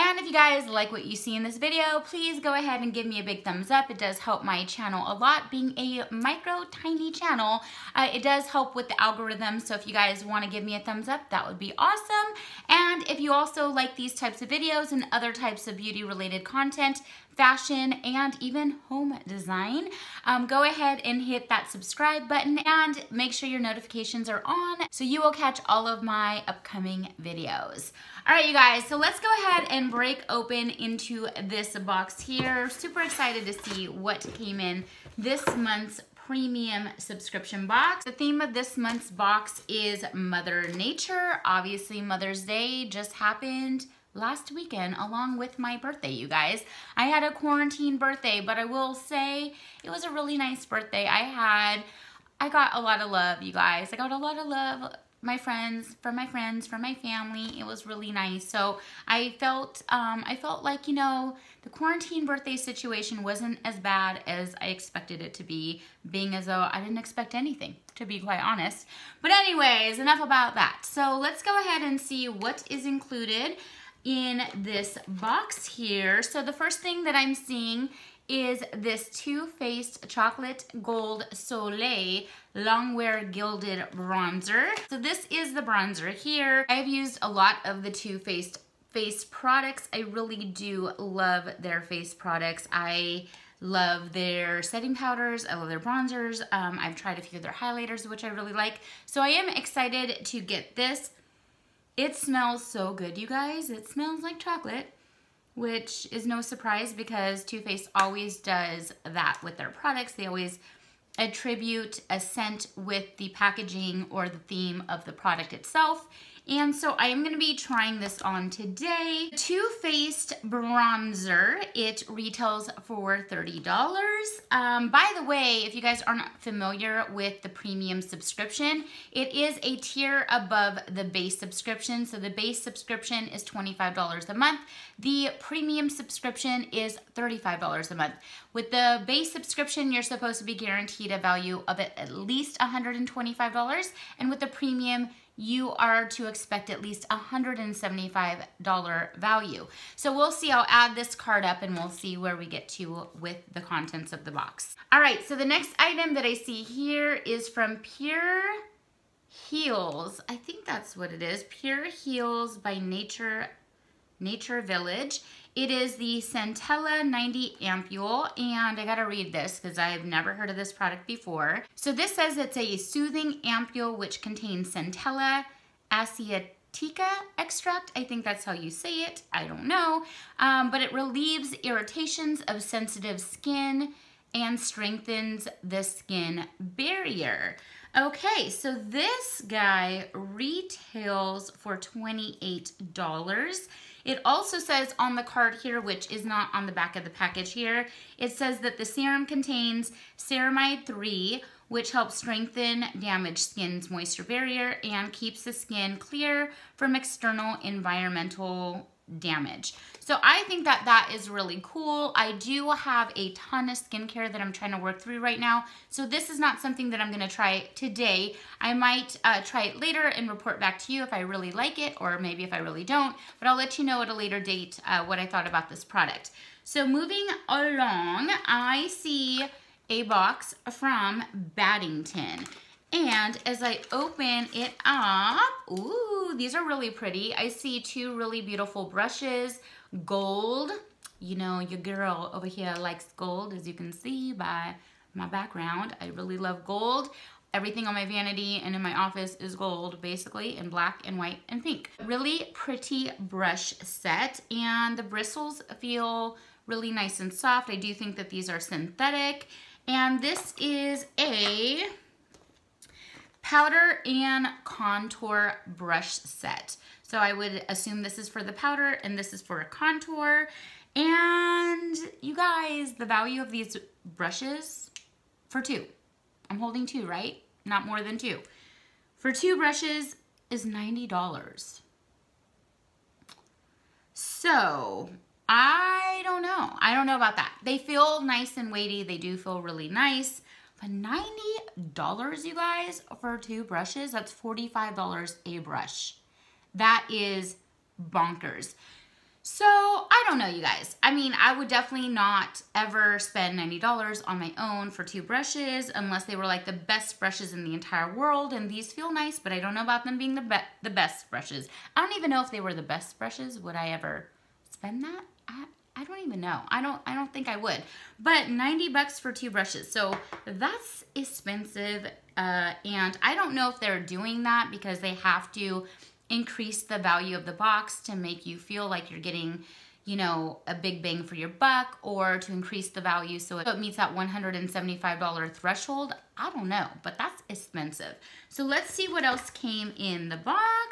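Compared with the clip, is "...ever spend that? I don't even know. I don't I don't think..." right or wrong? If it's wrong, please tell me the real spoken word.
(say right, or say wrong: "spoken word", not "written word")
right.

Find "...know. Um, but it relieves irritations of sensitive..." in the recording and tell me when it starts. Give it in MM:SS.
02:59.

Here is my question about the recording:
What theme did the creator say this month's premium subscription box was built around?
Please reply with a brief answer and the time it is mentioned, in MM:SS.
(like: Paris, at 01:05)
Mother Nature, at 00:40.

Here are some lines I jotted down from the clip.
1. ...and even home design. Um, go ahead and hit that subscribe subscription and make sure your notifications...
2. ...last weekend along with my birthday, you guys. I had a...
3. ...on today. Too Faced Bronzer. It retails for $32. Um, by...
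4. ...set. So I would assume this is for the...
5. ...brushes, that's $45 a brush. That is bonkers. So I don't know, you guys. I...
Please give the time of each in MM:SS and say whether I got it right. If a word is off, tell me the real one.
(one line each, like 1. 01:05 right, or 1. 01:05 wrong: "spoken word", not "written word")
1. 00:18 wrong: "button", not "subscription"
2. 00:44 right
3. 01:58 wrong: "30", not "32"
4. 04:26 right
5. 04:53 right.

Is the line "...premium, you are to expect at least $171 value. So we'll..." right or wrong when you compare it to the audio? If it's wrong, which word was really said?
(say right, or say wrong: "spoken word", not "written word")
wrong: "175", not "171".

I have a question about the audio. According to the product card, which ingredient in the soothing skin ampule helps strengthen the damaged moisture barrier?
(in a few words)
ceramide 3.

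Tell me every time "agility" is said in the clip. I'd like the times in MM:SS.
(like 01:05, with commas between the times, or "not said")
not said.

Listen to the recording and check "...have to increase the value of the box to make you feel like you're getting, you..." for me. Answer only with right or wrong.
right.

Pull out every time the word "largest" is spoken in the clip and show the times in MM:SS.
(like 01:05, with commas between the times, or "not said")
not said.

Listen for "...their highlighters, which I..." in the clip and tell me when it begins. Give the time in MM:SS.
01:37.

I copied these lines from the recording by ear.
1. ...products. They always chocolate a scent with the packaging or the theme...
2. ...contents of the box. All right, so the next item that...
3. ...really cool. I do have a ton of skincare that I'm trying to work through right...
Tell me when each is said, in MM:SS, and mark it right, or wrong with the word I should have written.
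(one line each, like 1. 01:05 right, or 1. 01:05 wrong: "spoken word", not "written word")
1. 01:49 wrong: "attribute", not "chocolate"
2. 02:33 right
3. 03:31 right.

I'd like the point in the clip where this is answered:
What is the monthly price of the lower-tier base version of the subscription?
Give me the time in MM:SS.
02:13.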